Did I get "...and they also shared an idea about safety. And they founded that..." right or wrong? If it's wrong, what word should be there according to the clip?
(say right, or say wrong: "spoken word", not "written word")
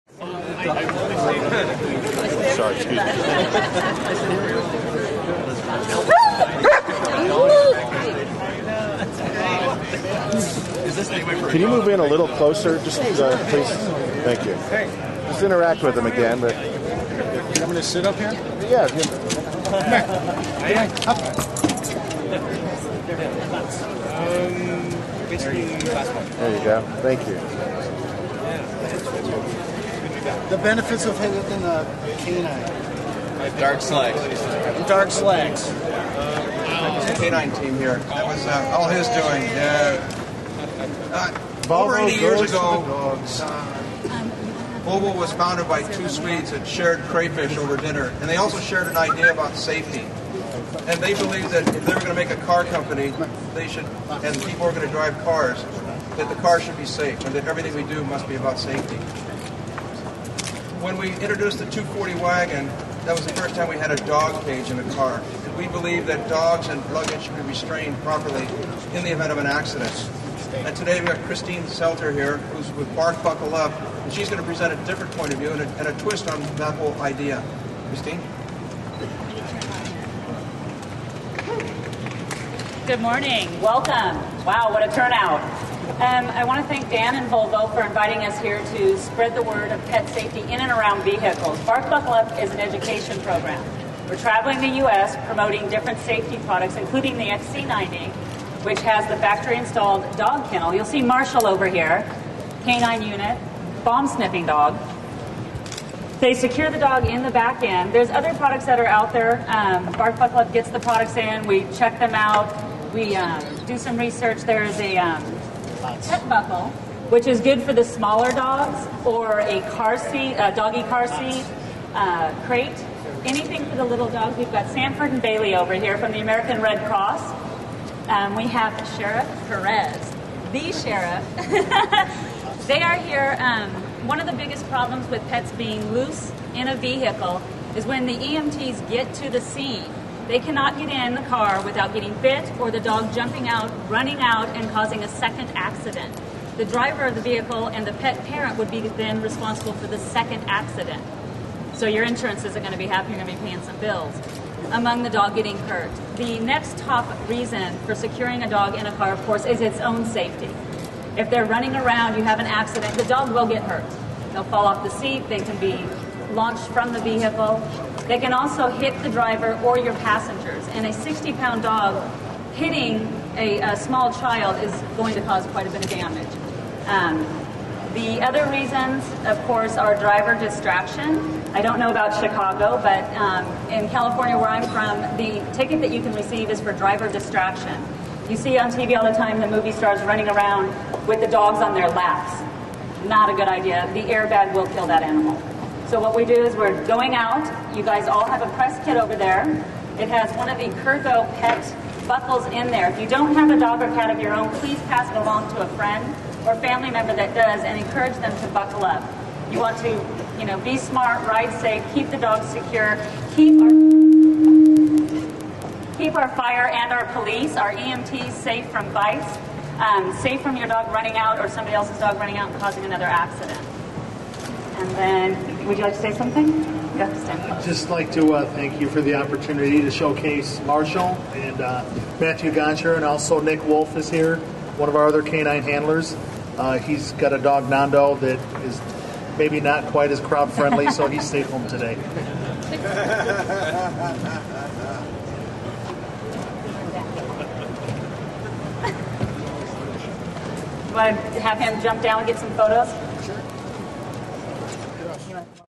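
wrong: "believed", not "founded".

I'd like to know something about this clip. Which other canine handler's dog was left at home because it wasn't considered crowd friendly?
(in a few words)
Nando.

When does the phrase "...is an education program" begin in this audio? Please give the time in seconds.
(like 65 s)
92 s.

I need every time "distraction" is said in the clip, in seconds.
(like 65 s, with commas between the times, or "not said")
180 s, 187 s.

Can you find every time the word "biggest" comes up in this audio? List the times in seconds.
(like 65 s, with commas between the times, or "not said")
134 s.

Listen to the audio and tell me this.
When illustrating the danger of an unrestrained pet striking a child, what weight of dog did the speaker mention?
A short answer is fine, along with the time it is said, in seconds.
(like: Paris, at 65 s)
60 pounds, at 170 s.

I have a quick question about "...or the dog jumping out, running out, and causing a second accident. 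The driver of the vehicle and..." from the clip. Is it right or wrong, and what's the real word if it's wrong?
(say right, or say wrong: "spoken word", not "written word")
right.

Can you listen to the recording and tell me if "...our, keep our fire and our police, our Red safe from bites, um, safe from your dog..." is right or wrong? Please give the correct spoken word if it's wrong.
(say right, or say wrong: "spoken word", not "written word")
wrong: "EMTs", not "Red".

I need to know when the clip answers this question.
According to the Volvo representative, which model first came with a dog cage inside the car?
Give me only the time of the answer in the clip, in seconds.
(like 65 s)
61 s.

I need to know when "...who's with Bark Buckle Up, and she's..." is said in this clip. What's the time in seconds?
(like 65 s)
72 s.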